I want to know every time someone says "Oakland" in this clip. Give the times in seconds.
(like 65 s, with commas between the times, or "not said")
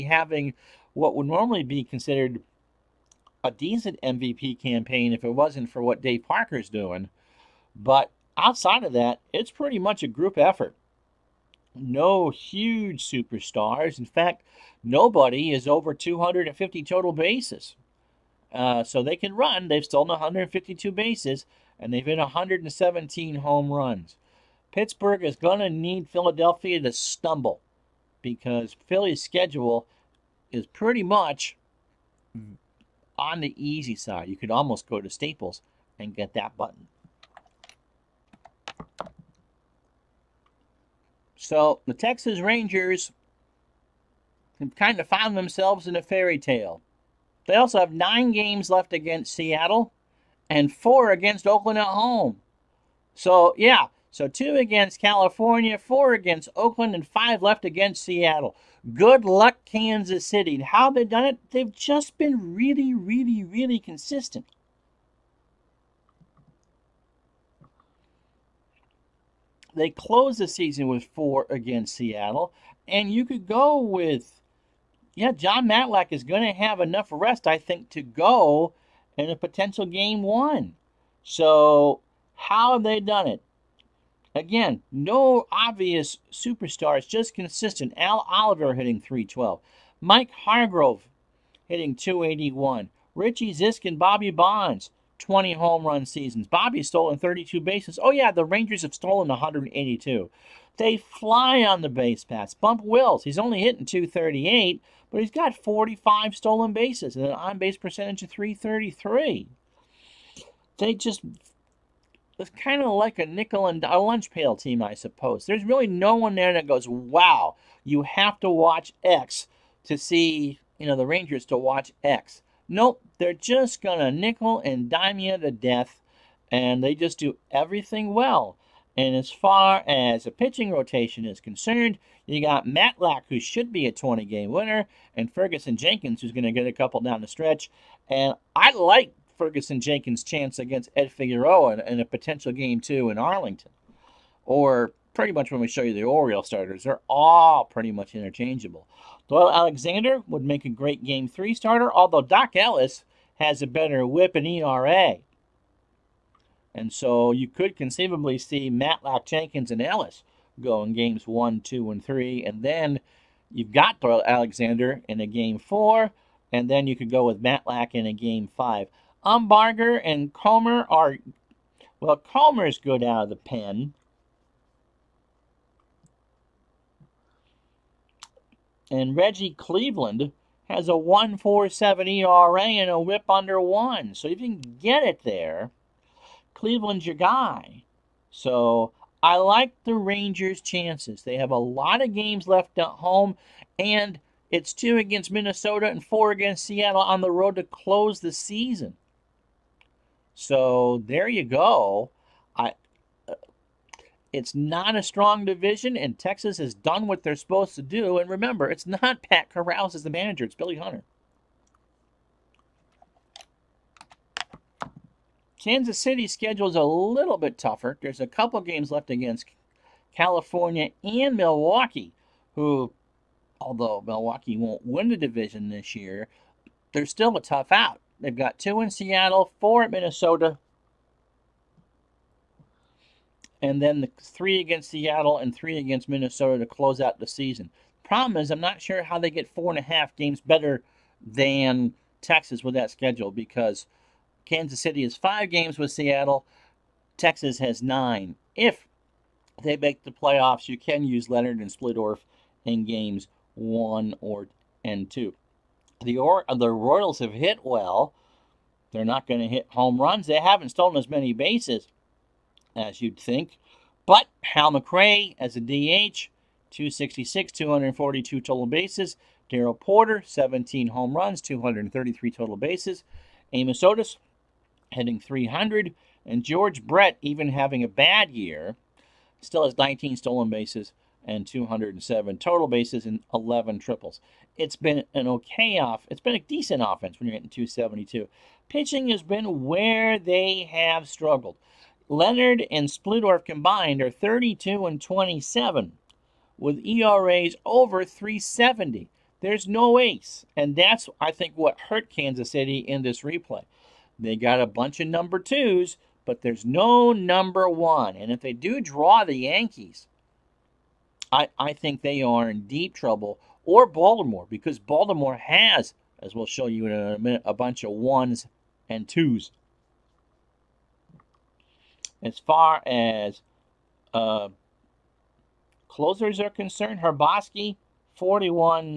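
51 s, 56 s.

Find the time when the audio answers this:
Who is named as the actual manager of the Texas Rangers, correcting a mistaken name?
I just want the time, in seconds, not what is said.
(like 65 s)
210 s.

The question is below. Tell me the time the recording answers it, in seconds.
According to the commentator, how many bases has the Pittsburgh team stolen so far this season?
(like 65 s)
20 s.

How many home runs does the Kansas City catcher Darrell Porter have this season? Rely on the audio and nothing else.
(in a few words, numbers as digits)
17.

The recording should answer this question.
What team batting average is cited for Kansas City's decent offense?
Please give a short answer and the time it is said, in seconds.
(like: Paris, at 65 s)
272, at 287 s.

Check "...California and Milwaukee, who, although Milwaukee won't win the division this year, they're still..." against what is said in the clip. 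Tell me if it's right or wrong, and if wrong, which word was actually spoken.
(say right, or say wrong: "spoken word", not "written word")
right.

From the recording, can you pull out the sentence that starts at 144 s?
Or pretty much when we show you the Oriole starters, they're all pretty much interchangeable.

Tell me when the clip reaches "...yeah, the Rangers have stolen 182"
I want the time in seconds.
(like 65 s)
98 s.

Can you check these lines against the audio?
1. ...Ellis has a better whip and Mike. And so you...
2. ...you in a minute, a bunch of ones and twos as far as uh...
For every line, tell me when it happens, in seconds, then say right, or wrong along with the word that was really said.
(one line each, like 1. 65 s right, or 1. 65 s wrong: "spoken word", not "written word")
1. 152 s wrong: "ERA", not "Mike"
2. 316 s right.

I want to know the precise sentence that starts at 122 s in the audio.
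Nope, they're just going to nickel and dime you to death, and they just do everything well.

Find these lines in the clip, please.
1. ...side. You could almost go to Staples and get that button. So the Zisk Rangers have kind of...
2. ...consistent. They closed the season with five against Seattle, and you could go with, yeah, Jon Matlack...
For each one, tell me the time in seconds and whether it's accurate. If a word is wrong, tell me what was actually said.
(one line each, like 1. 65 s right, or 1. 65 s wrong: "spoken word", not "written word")
1. 33 s wrong: "Texas", not "Zisk"
2. 63 s wrong: "four", not "five".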